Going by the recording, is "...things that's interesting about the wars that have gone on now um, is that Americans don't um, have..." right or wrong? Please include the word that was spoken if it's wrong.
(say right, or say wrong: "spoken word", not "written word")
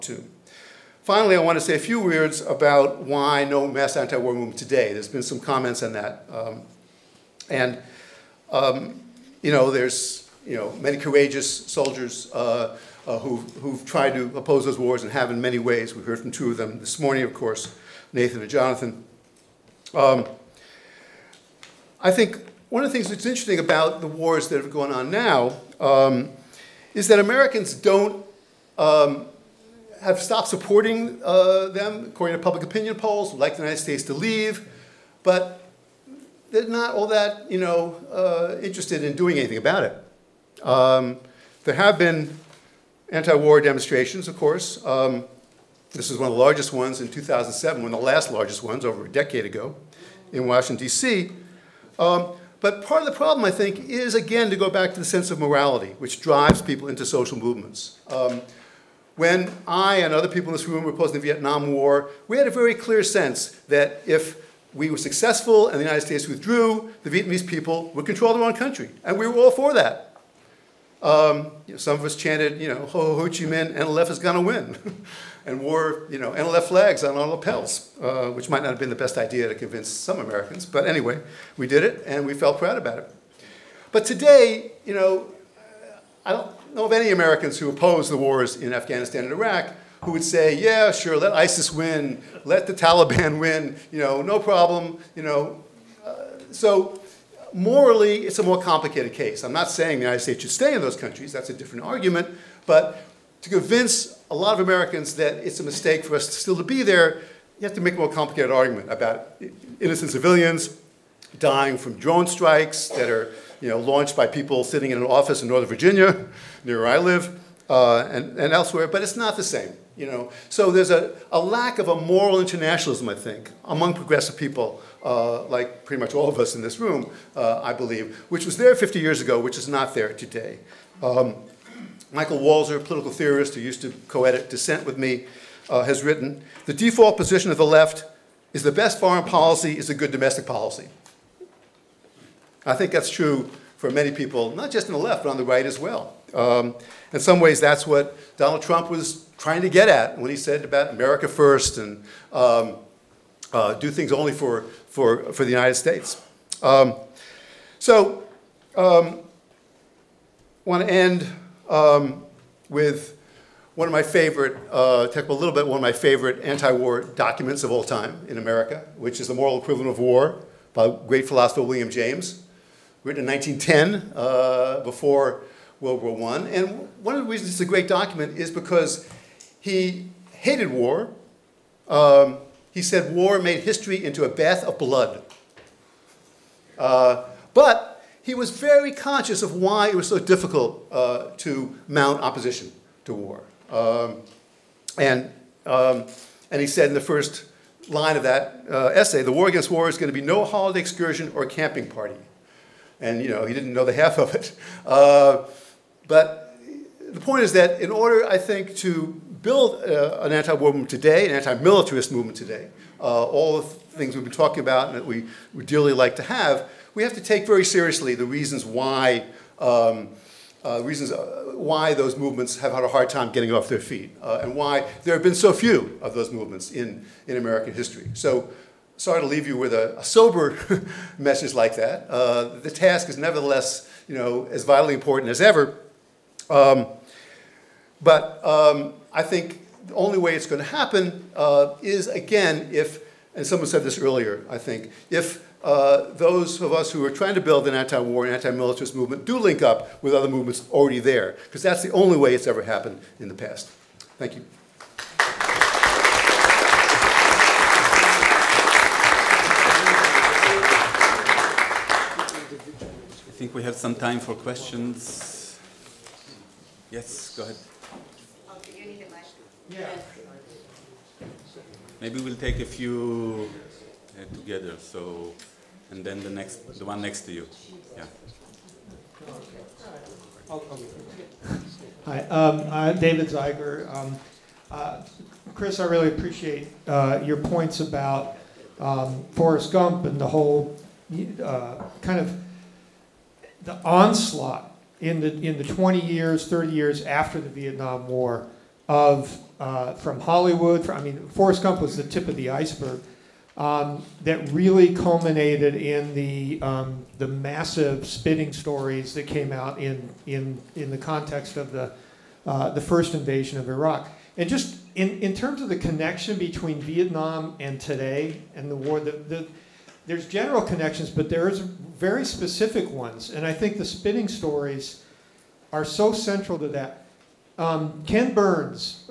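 right.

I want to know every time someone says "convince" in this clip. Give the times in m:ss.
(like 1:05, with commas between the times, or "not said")
1:19, 1:43.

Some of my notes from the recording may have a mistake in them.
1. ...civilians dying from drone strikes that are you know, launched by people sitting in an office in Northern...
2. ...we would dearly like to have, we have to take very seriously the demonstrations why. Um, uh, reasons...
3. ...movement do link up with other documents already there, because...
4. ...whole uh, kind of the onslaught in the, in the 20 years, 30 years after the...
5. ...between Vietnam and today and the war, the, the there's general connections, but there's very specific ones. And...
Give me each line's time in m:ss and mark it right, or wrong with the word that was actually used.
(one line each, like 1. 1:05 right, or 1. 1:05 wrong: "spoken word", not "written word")
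1. 1:50 right
2. 3:35 wrong: "reasons", not "demonstrations"
3. 4:08 wrong: "movements", not "documents"
4. 4:50 right
5. 5:16 right.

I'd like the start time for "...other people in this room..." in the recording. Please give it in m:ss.
1:00.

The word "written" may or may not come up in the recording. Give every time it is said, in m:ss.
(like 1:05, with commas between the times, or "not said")
2:16, 2:53.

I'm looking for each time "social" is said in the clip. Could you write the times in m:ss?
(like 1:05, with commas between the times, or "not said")
0:57.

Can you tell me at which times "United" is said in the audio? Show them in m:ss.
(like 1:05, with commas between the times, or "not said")
0:33, 1:05, 1:40, 2:35.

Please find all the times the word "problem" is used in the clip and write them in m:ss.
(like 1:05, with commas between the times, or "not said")
0:53, 1:34.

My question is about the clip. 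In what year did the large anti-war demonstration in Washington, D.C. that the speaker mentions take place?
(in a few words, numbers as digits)
2007.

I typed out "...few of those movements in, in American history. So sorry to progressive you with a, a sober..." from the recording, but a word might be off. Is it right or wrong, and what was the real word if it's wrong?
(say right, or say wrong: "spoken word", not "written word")
wrong: "leave", not "progressive".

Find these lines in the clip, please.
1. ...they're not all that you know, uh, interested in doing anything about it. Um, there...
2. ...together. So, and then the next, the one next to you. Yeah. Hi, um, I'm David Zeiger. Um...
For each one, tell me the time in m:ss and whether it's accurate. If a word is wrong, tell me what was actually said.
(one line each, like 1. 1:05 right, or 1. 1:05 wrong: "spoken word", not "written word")
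1. 0:36 right
2. 4:34 right.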